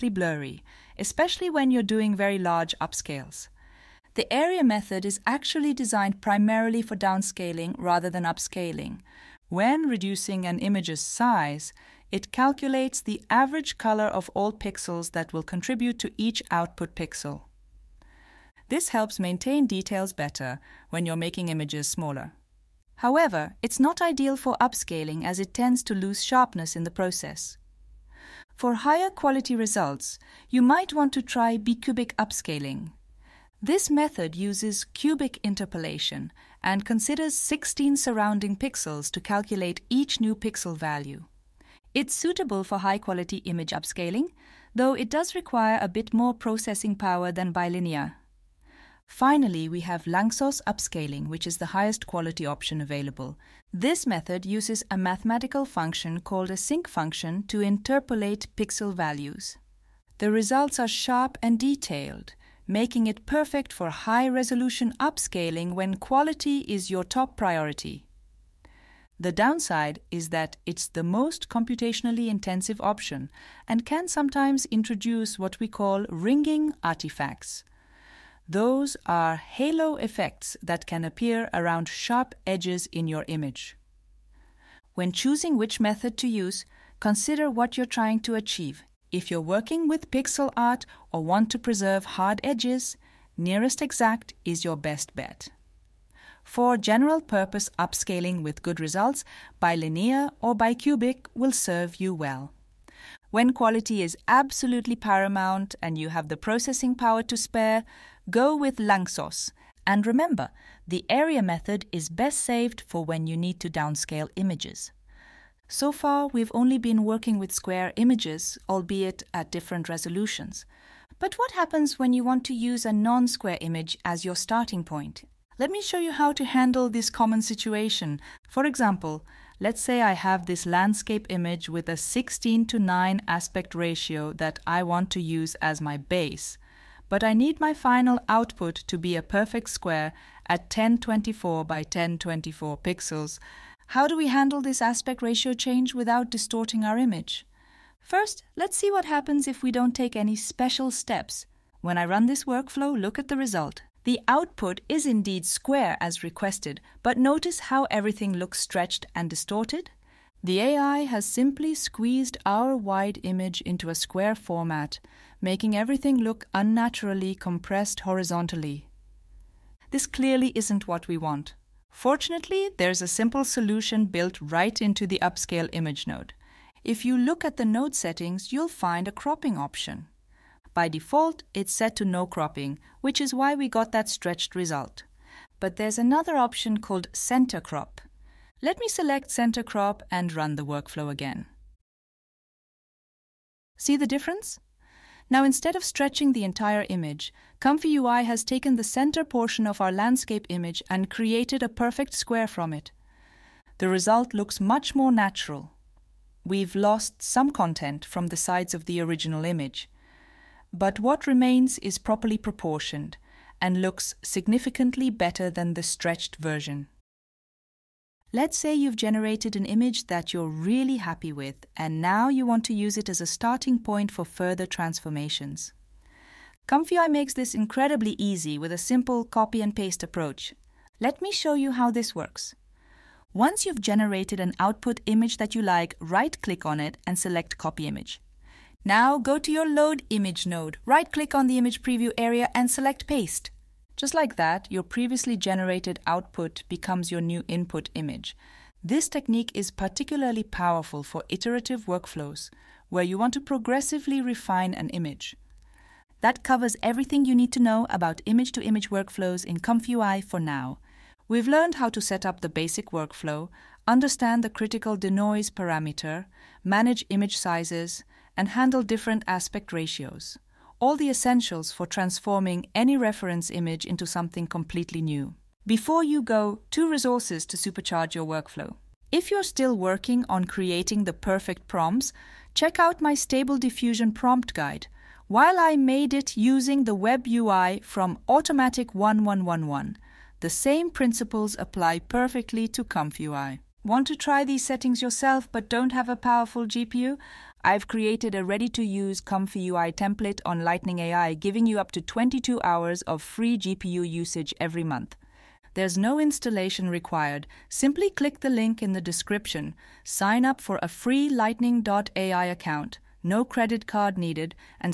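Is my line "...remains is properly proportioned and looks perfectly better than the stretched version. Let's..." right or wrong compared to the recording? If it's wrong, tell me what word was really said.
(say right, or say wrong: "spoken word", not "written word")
wrong: "significantly", not "perfectly".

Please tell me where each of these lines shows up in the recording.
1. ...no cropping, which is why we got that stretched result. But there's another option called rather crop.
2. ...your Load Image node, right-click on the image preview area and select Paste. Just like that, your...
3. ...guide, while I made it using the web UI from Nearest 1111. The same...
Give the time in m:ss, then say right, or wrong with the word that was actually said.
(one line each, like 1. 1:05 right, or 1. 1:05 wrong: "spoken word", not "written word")
1. 3:02 wrong: "center", not "rather"
2. 3:59 right
3. 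4:44 wrong: "Automatic", not "Nearest".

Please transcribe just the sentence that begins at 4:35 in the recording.
Before you go, two resources to supercharge your workflow.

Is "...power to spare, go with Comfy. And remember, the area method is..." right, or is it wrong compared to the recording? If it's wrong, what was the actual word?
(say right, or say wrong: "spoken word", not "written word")
wrong: "Lanczos", not "Comfy".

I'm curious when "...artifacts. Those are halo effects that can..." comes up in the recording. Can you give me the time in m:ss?
1:16.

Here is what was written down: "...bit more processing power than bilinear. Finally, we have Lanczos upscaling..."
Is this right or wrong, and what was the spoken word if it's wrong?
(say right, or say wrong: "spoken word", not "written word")
right.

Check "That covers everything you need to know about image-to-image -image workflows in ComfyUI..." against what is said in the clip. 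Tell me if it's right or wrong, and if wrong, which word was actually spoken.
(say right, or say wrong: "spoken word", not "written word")
right.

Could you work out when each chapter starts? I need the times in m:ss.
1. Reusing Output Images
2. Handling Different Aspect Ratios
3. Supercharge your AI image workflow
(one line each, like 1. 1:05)
1. 3:38
2. 1:55
3. 4:35.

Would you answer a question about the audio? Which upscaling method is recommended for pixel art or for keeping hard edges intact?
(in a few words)
Nearest Exact.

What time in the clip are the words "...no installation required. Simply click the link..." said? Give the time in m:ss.
5:05.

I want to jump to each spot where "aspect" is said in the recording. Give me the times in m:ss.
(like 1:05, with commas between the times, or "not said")
2:13, 2:24, 4:29.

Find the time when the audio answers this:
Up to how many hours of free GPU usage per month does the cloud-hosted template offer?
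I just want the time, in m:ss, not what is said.
5:02.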